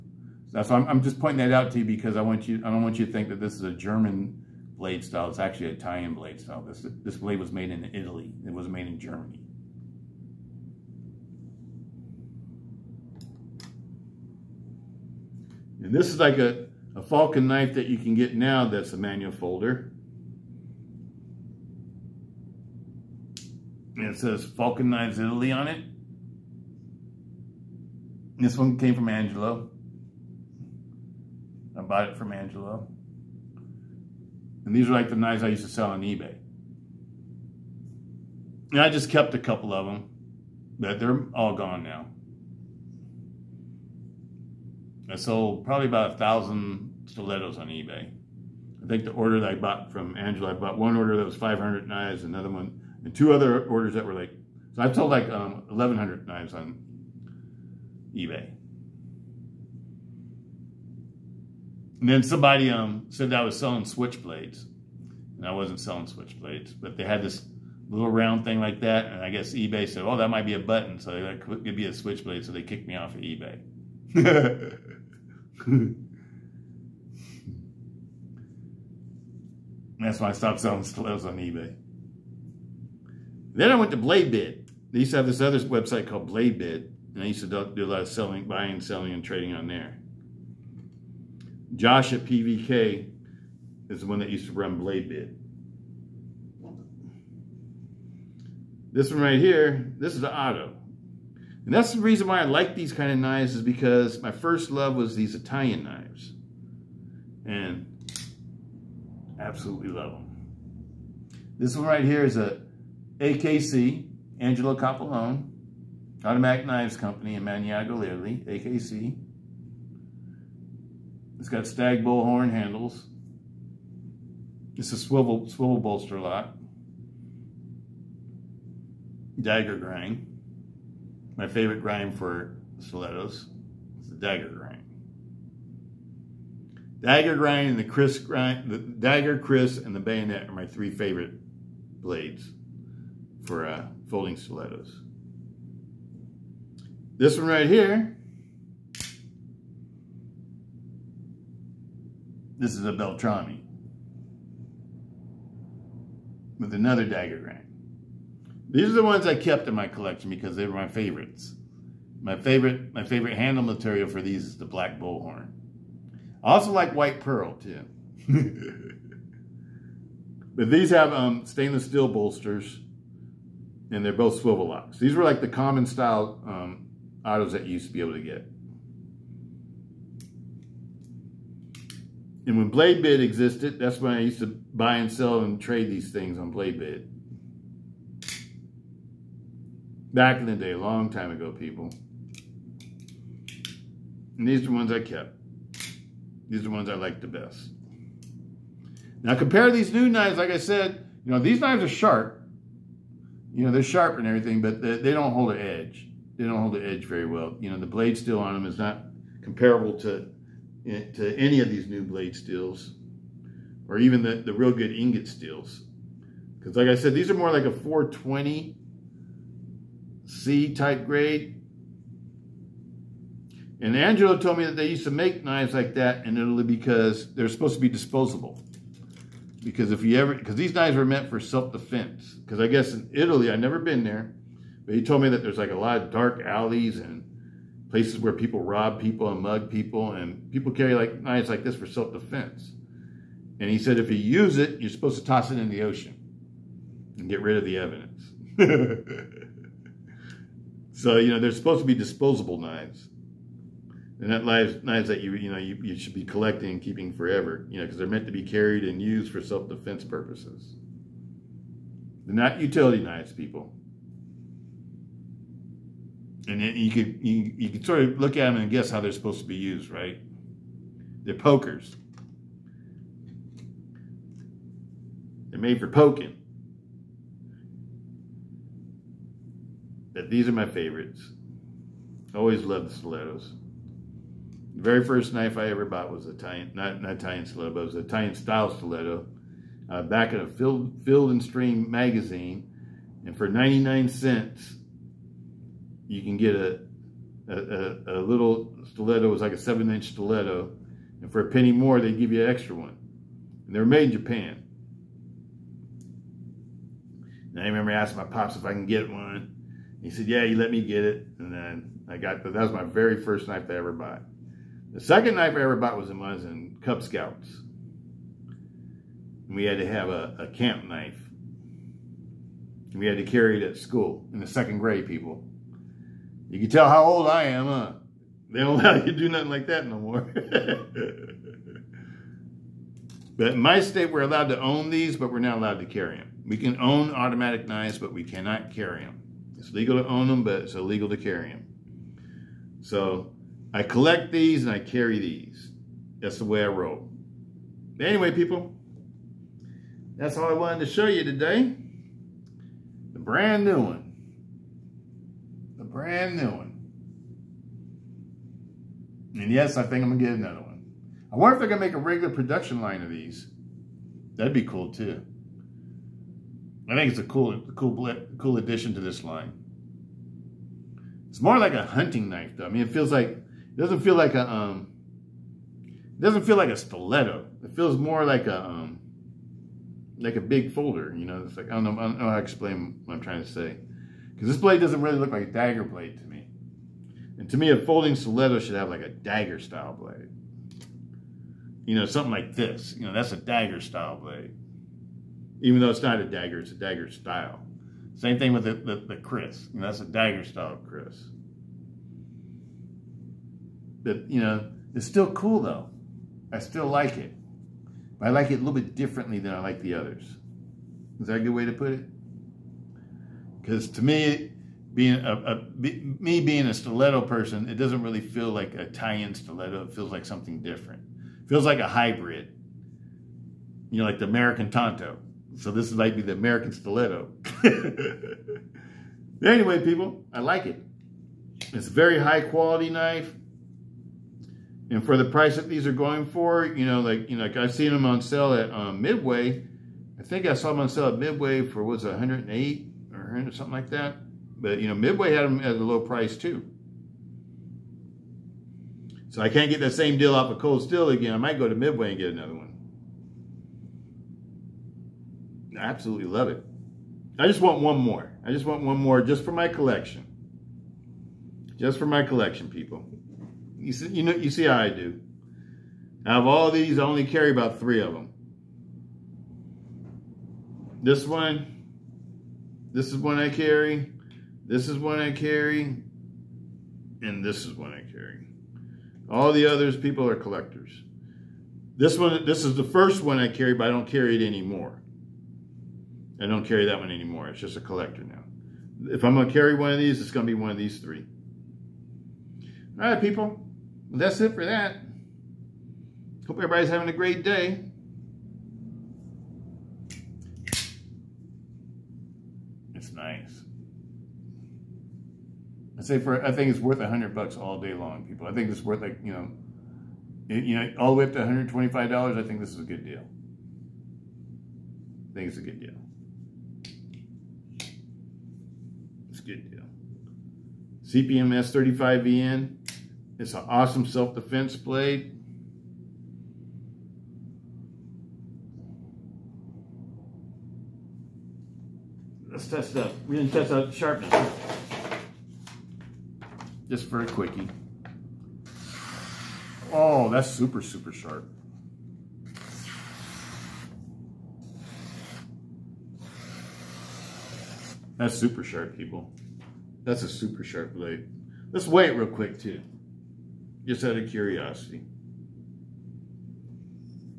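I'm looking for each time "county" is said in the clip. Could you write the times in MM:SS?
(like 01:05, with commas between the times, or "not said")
not said.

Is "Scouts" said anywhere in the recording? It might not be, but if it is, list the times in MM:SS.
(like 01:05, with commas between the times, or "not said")
05:17.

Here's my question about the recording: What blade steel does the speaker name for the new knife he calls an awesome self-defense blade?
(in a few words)
CPM S35VN.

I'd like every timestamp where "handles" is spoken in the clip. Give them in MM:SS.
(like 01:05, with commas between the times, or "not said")
02:02, 02:43.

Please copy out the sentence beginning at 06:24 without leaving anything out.
Because this blade doesn't really look like a dagger blade to me.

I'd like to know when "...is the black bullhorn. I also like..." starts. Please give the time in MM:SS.
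02:44.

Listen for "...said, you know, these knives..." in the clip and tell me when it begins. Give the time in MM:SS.
03:20.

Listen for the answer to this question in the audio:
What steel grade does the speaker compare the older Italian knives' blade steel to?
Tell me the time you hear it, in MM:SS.
03:37.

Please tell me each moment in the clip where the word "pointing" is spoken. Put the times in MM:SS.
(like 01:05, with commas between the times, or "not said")
00:01.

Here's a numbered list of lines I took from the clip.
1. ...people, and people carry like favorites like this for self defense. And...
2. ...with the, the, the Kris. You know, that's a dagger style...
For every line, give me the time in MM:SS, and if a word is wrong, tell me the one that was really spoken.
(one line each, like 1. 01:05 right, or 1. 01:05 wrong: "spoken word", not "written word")
1. 03:59 wrong: "knives", not "favorites"
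2. 06:38 right.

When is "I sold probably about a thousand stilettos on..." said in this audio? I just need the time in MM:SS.
00:45.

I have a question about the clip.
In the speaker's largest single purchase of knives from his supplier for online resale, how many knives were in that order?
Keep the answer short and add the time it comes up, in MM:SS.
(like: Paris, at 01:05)
500, at 00:51.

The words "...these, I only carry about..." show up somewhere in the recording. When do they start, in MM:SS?
07:46.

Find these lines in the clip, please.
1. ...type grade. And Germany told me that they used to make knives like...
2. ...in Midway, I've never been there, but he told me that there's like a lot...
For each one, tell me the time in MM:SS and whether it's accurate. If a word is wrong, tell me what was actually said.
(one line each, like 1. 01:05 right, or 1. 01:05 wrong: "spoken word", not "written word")
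1. 03:40 wrong: "Angelo", not "Germany"
2. 03:52 wrong: "Italy", not "Midway".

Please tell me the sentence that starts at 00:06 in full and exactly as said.
This this blade was made in Italy.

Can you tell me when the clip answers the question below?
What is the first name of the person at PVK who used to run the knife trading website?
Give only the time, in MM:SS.
01:31.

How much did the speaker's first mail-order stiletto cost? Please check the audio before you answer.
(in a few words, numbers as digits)
99 cents.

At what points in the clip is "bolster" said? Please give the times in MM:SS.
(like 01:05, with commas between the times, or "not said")
02:05, 02:52.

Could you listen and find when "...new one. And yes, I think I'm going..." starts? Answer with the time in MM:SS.
05:56.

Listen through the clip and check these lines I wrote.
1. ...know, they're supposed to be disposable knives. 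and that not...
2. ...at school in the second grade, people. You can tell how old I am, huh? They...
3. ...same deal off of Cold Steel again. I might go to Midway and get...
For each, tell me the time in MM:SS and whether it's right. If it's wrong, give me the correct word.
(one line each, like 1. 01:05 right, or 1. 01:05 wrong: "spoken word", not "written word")
1. 04:11 right
2. 05:23 right
3. 07:29 right.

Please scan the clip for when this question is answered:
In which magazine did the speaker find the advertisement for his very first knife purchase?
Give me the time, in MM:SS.
04:51.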